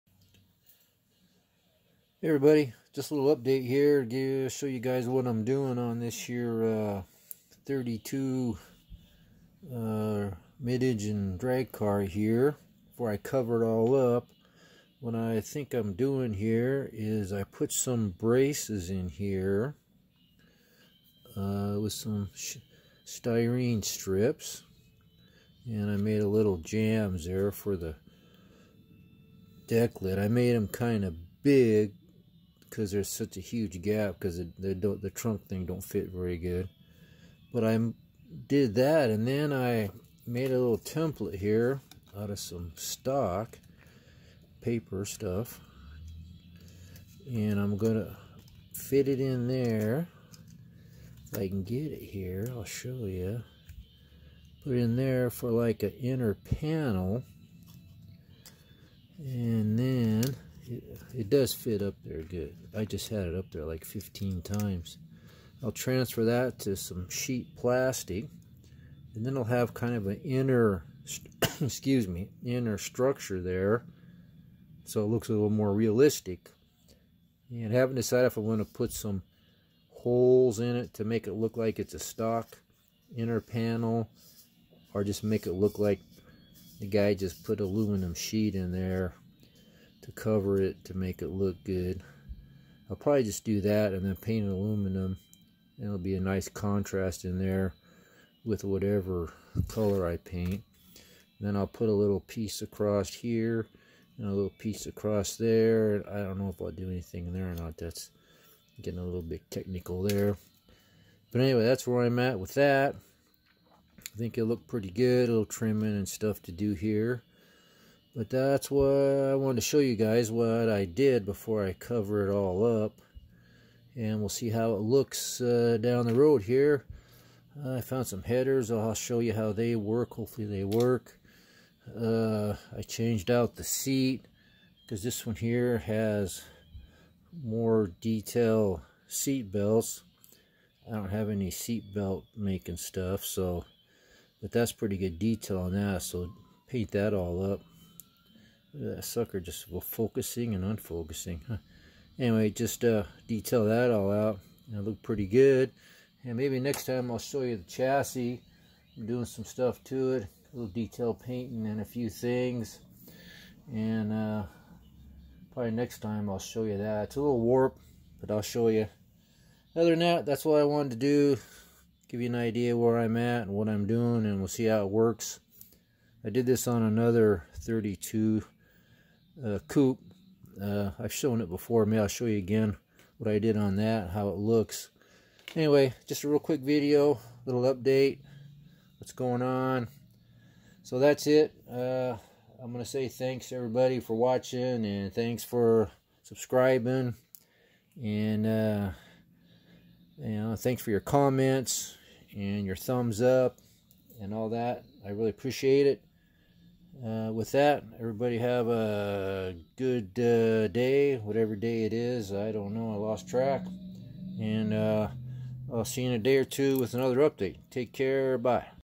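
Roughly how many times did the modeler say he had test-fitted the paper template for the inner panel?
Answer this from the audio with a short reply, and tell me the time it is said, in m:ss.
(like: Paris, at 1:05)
15, at 1:03.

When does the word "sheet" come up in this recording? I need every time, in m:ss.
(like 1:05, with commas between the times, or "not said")
1:07, 1:28.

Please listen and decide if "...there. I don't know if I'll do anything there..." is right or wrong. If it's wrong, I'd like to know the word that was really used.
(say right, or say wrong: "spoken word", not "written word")
right.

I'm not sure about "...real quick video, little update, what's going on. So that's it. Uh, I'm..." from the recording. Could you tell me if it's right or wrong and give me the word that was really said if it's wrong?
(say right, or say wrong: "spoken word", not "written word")
right.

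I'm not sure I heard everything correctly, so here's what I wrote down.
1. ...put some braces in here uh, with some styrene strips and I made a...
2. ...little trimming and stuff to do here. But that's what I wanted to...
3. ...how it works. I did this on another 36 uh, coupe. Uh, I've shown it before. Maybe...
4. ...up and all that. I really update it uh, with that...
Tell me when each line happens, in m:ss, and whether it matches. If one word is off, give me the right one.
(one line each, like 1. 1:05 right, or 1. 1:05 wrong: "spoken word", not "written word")
1. 0:17 right
2. 1:55 right
3. 2:54 wrong: "32", not "36"
4. 3:23 wrong: "appreciate", not "update".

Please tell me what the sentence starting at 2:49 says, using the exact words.
Other than that, that's what I wanted to do.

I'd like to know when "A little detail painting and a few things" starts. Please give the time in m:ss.
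2:40.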